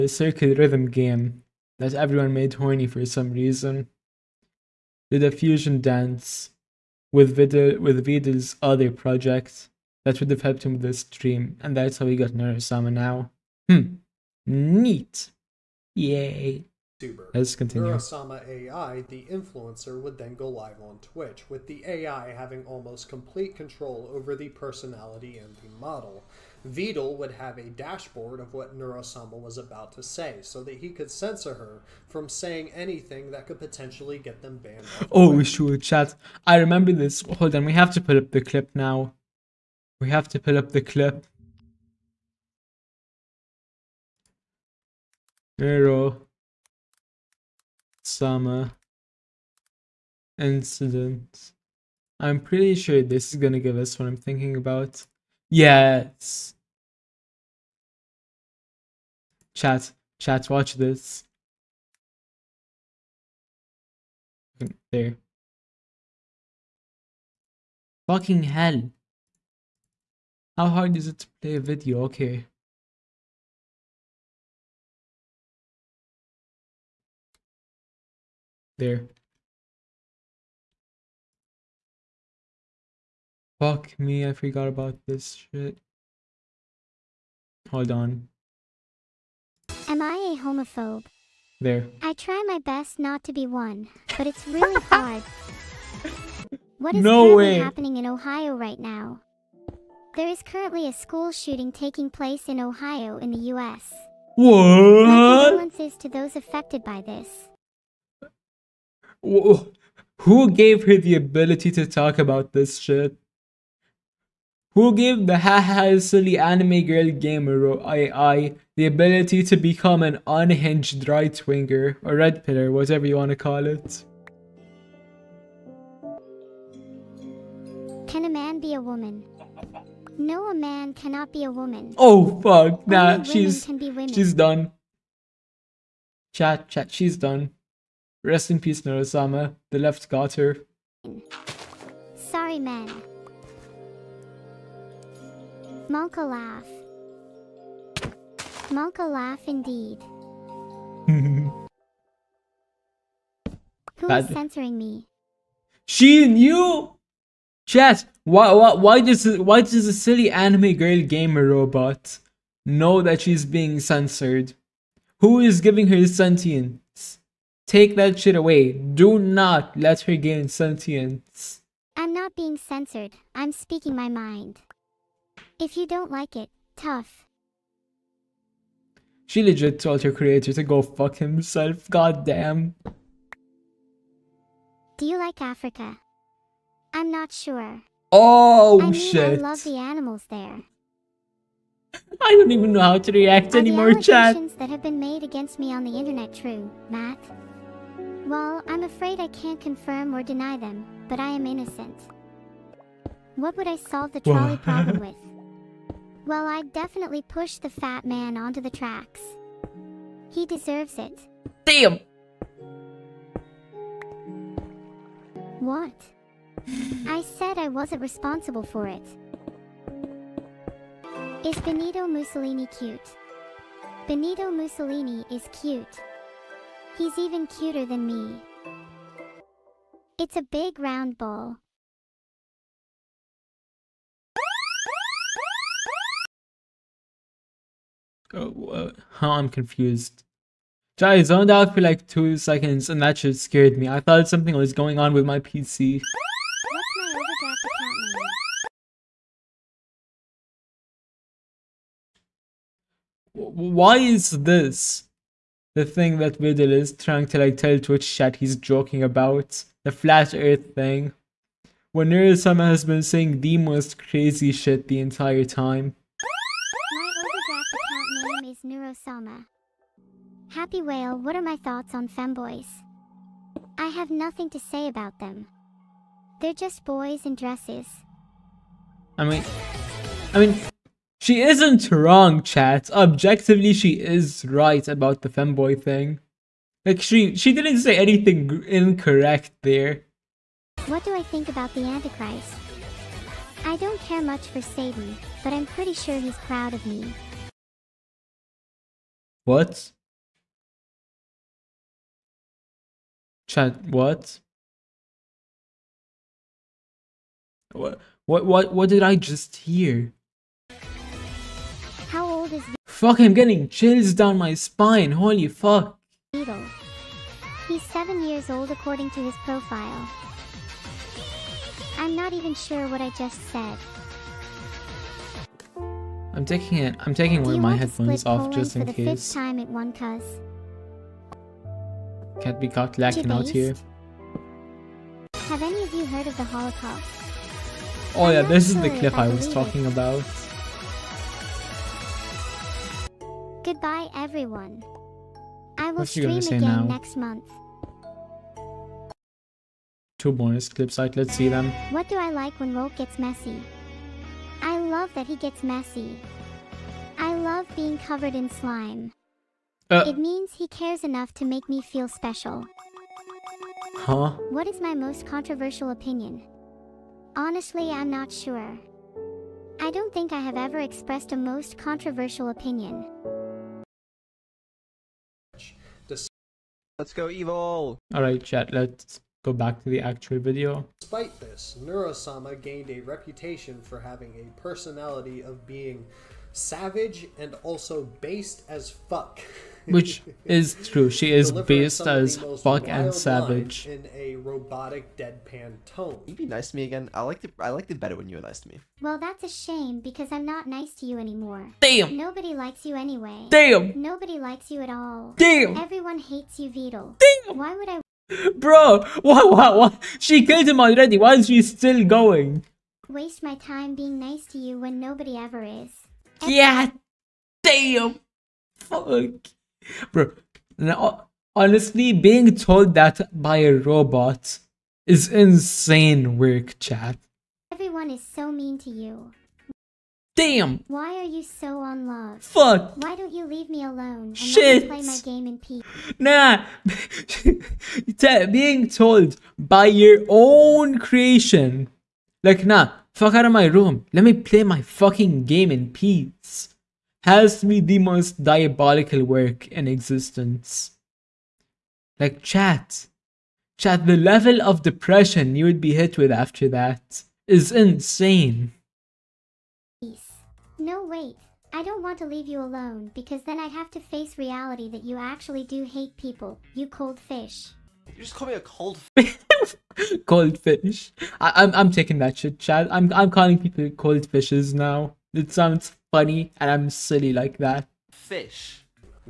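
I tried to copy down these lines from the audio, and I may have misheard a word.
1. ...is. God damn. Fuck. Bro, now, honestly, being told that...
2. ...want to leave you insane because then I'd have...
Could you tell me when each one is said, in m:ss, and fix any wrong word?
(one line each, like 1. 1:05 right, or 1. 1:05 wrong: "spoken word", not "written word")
1. 6:55 right
2. 7:42 wrong: "alone", not "insane".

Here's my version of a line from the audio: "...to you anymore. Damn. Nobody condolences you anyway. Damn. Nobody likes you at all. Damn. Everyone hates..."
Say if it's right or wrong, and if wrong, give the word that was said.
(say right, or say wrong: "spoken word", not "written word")
wrong: "likes", not "condolences".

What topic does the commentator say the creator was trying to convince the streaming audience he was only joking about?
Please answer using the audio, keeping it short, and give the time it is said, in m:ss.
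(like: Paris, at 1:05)
Flat earth, at 4:19.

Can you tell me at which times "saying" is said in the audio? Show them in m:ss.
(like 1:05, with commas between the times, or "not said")
0:32, 4:23.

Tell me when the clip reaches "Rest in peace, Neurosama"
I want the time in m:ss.
2:18.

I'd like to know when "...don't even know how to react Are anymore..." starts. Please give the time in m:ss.
3:12.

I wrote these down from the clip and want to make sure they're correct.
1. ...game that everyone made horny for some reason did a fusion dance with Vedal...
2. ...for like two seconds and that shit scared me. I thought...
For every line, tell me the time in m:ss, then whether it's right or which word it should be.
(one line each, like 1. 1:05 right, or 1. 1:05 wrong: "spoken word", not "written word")
1. 0:00 right
2. 4:01 right.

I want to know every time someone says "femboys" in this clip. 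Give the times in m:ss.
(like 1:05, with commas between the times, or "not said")
4:32, 4:45.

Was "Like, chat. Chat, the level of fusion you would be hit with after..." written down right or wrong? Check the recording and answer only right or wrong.
wrong.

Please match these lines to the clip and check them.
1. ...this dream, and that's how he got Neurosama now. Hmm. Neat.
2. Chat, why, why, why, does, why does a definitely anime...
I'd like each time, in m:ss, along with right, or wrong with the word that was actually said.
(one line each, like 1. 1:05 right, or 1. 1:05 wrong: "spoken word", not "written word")
1. 0:10 right
2. 2:37 wrong: "silly", not "definitely".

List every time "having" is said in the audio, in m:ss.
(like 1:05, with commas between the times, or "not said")
0:22, 6:24.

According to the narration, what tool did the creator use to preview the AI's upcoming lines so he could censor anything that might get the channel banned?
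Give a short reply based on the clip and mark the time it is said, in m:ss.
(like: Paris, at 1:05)
Dashboard, at 0:27.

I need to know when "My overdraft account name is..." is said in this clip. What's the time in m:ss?
4:27.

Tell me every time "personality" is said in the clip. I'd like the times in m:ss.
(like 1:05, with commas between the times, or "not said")
0:24, 6:24.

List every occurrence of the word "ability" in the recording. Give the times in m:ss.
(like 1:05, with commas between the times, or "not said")
1:51, 1:58.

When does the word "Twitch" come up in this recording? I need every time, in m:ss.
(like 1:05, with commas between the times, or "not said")
0:20, 4:17.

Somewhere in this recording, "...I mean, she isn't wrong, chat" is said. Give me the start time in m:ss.
4:40.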